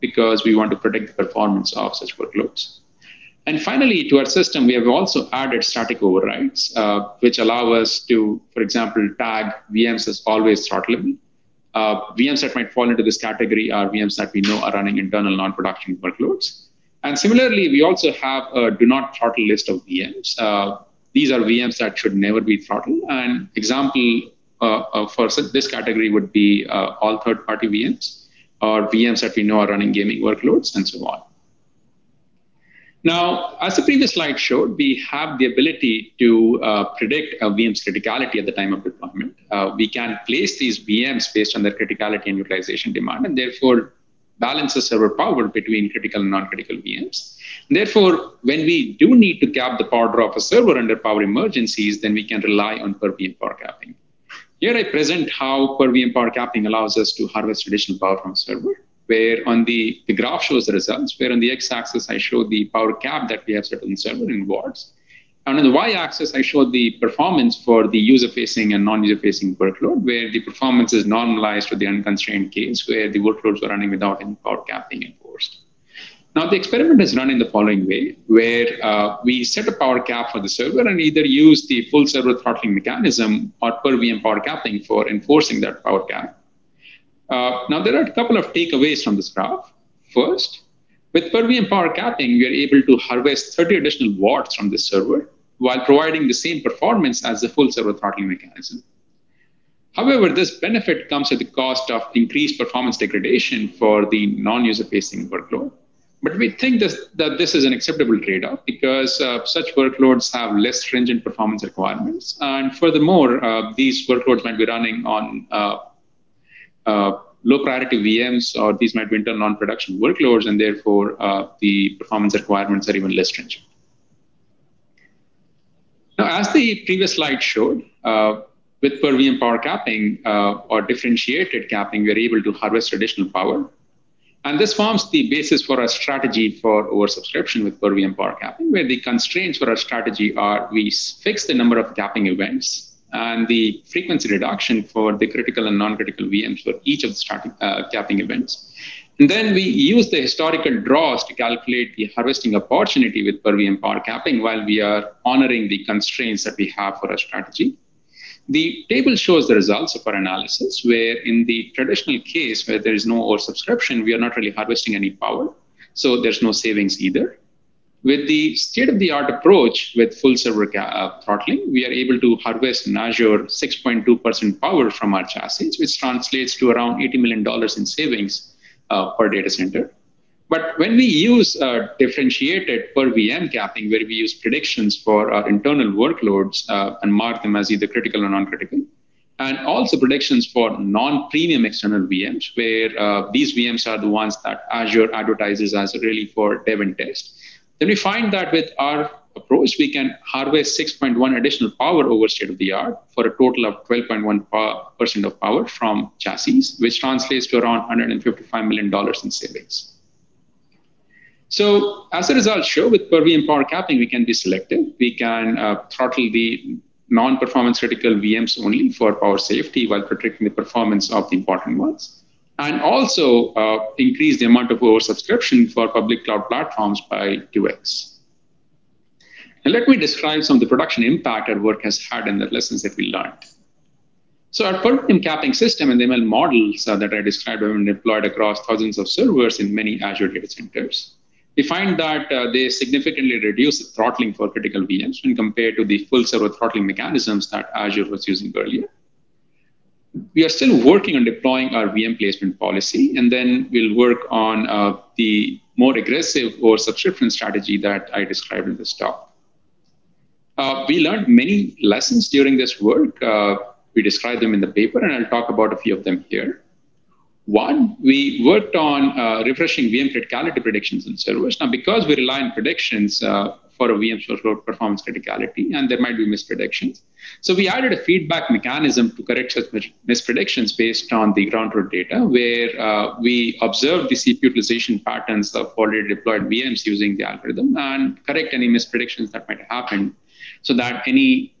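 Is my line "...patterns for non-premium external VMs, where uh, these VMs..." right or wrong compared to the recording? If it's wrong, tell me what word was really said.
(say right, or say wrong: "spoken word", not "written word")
wrong: "predictions", not "patterns".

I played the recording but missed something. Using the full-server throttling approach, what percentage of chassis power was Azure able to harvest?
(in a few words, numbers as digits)
6.2%.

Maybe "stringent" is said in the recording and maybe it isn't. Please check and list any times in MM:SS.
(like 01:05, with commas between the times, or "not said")
01:50, 02:03.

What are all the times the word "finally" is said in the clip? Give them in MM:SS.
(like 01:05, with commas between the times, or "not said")
00:03.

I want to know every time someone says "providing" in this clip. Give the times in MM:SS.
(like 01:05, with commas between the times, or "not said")
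01:35.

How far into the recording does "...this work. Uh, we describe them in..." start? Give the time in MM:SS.
04:22.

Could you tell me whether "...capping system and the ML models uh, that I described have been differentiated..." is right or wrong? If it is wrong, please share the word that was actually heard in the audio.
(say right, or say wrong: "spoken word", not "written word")
wrong: "deployed", not "differentiated".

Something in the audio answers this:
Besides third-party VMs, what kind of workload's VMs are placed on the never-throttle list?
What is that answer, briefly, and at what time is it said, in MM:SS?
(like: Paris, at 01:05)
Gaming, at 00:29.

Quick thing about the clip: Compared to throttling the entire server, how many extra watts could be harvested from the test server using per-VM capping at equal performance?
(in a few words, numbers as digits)
30.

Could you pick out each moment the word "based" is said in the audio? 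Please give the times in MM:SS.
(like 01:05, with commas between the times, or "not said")
00:41, 04:40.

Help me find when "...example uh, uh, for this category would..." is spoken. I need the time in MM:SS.
00:23.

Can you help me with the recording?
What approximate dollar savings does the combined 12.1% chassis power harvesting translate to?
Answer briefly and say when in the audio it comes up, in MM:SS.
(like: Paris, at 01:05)
$155 million, at 03:27.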